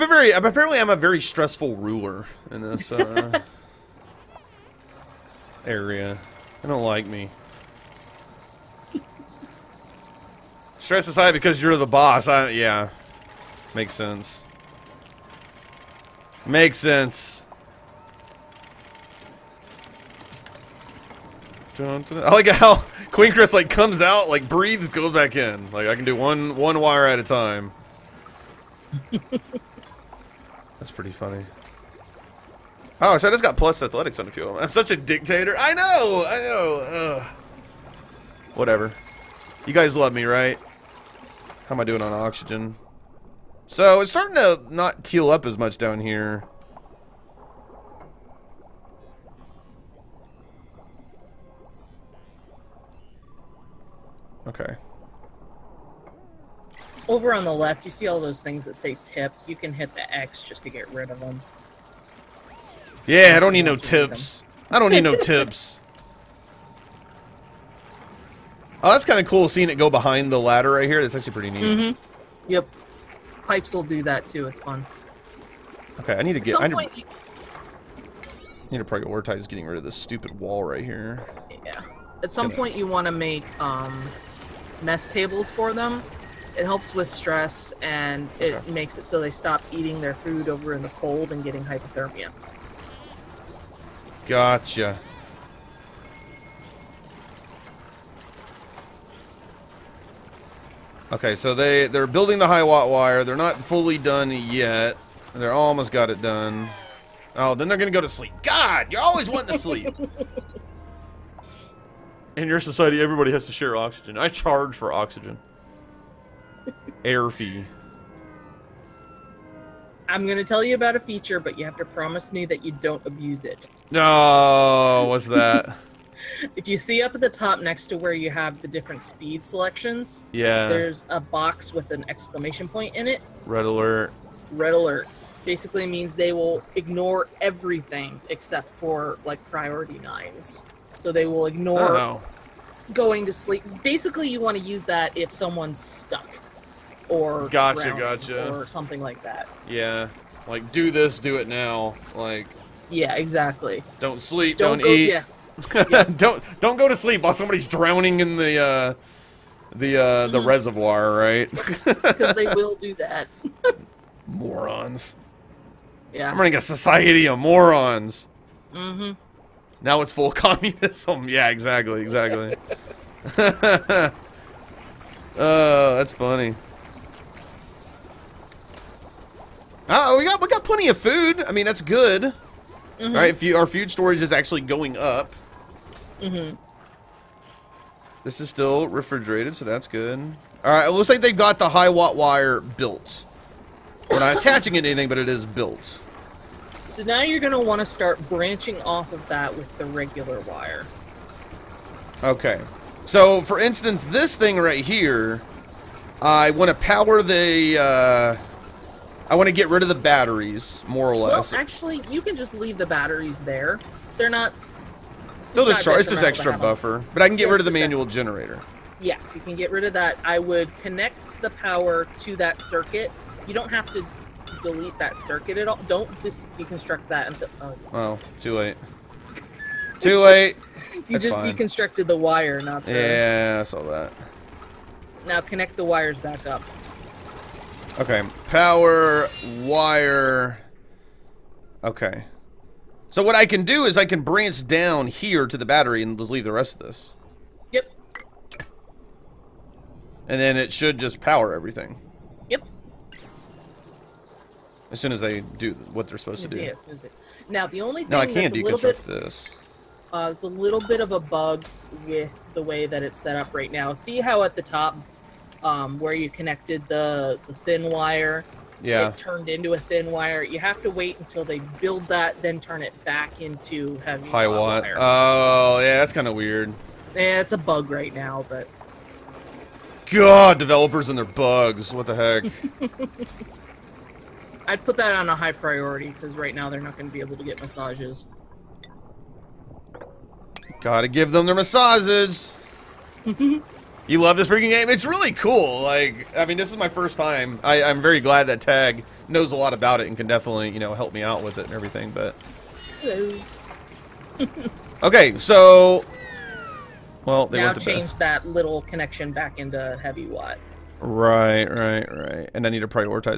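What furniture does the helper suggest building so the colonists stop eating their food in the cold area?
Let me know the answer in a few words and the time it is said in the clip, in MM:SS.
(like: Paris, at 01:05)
Mess tables, at 01:24.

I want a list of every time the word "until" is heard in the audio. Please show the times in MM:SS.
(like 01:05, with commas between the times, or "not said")
03:47, 04:31.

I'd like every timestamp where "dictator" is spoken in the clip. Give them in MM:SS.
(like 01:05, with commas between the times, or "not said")
00:34.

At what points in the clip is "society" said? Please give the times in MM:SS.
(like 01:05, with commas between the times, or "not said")
01:52, 02:46.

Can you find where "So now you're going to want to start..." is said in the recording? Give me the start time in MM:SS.
03:16.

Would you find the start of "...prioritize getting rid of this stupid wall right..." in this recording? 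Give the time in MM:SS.
01:18.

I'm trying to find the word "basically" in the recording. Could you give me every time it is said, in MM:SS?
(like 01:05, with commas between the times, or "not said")
02:15, 02:23.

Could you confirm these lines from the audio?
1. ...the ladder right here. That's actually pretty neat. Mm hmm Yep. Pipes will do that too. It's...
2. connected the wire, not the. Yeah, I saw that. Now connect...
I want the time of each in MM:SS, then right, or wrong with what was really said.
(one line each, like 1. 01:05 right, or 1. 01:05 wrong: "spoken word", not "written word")
1. 01:10 right
2. 03:51 wrong: "deconstructed", not "connected".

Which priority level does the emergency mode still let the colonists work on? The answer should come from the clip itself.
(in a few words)
Priority nines.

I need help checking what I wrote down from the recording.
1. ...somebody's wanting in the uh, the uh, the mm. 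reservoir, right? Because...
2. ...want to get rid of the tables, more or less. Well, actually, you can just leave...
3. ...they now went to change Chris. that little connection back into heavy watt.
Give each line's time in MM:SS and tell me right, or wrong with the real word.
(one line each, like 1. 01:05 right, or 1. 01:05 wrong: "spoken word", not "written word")
1. 02:37 wrong: "drowning", not "wanting"
2. 03:29 wrong: "batteries", not "tables"
3. 05:07 wrong: "Beth", not "Chris".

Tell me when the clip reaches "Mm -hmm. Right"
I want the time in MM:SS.
03:02.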